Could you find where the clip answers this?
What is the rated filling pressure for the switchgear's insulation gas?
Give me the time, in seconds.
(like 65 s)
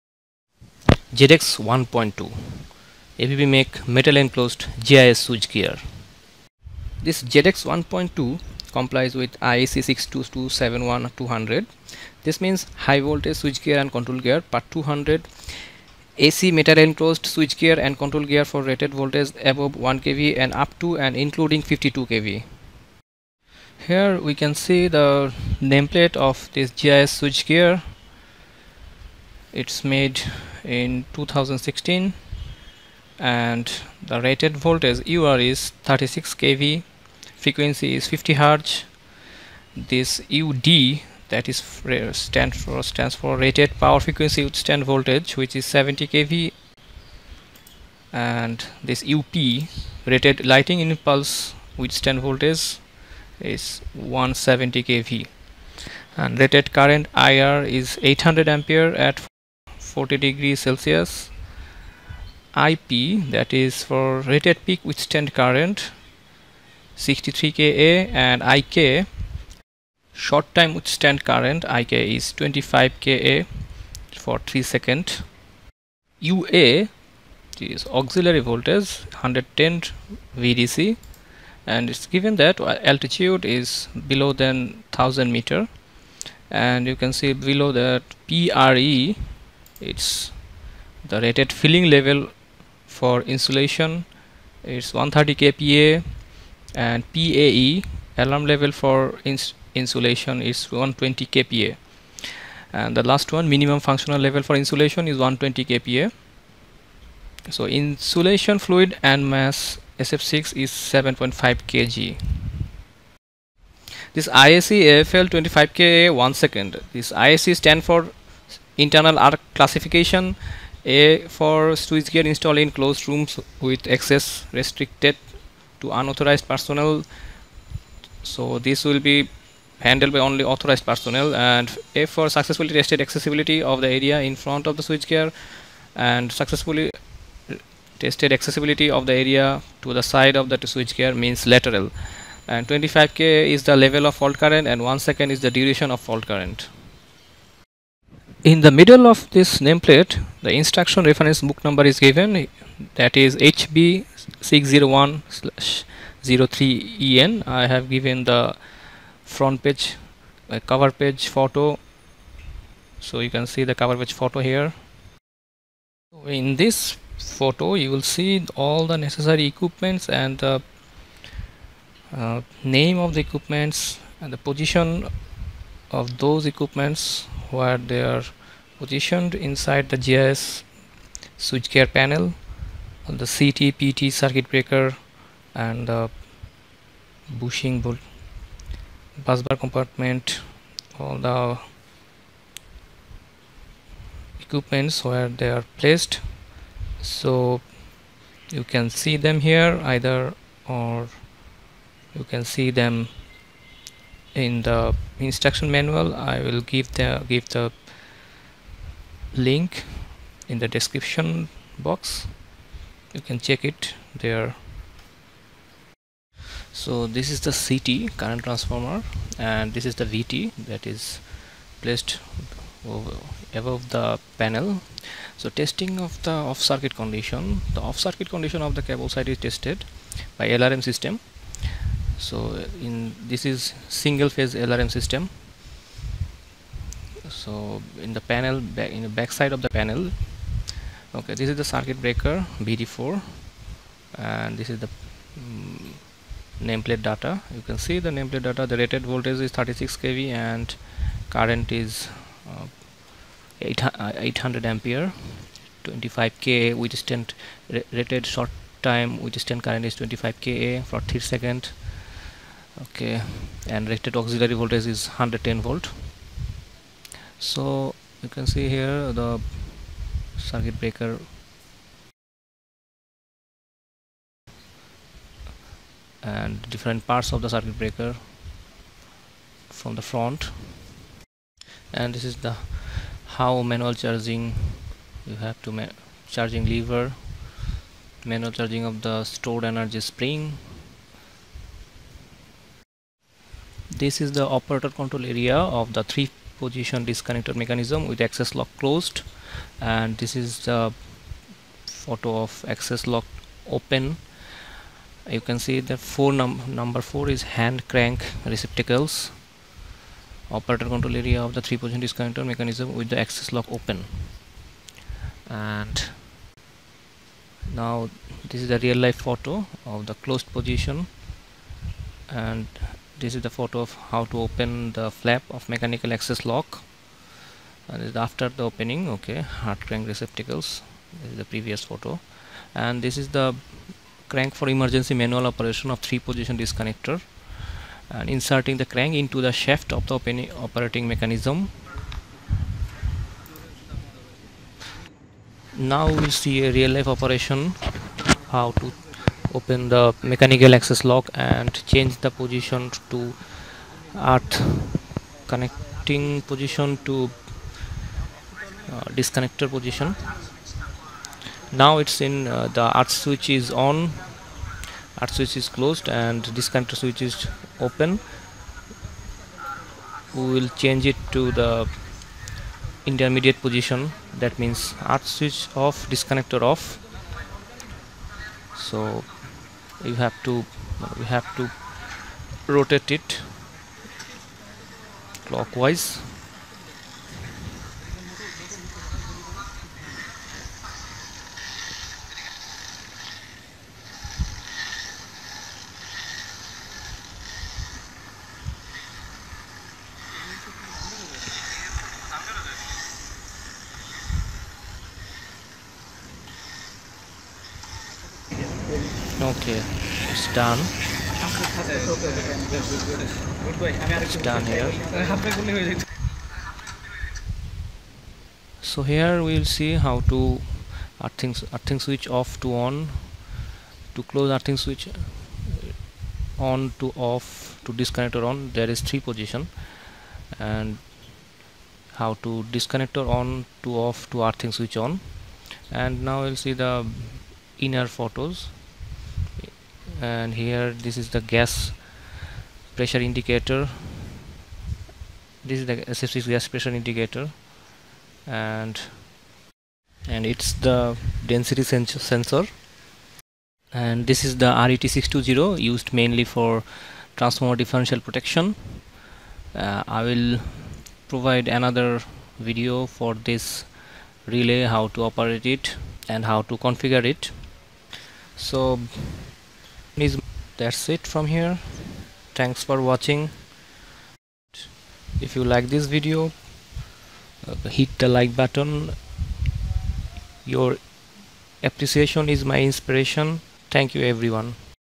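94 s.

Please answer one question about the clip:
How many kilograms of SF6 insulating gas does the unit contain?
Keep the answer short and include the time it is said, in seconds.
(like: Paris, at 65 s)
7.5 kg, at 110 s.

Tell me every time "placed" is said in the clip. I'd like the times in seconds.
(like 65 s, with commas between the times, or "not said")
195 s, 221 s.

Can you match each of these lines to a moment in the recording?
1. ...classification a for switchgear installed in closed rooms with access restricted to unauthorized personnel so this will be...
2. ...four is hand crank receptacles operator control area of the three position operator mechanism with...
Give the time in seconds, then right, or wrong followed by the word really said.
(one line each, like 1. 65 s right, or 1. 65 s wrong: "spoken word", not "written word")
1. 119 s right
2. 307 s wrong: "disconnector", not "operator".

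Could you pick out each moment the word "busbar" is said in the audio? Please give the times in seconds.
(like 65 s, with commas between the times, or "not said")
189 s.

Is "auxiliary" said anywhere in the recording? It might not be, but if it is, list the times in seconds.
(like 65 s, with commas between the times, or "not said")
78 s, 264 s.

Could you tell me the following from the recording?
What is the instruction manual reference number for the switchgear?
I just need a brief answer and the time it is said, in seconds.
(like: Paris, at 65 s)
HB 601/03EN, at 153 s.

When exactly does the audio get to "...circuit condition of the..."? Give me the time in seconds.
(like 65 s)
227 s.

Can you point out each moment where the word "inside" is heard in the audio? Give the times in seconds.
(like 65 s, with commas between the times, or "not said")
179 s.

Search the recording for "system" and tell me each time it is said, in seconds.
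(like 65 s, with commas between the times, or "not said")
230 s, 234 s.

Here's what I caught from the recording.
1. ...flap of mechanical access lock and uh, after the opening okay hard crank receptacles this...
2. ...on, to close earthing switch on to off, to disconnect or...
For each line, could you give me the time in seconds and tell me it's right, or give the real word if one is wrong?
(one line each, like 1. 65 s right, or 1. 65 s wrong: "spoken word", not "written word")
1. 325 s right
2. 422 s right.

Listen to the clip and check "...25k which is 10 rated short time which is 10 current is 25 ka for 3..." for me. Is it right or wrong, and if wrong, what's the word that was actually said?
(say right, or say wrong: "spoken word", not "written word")
right.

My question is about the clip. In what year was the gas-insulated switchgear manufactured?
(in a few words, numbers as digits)
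2016.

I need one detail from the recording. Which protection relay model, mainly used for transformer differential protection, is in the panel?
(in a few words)
RET620.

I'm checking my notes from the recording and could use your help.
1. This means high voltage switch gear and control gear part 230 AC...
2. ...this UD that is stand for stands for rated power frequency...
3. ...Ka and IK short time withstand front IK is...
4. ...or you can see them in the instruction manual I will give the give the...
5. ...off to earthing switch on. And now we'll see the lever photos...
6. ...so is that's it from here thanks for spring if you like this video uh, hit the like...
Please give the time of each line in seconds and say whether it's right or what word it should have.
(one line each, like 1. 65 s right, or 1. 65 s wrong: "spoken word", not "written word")
1. 12 s wrong: "200", not "230"
2. 39 s right
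3. 67 s wrong: "current", not "front"
4. 200 s right
5. 433 s wrong: "inner", not "lever"
6. 468 s wrong: "watching", not "spring".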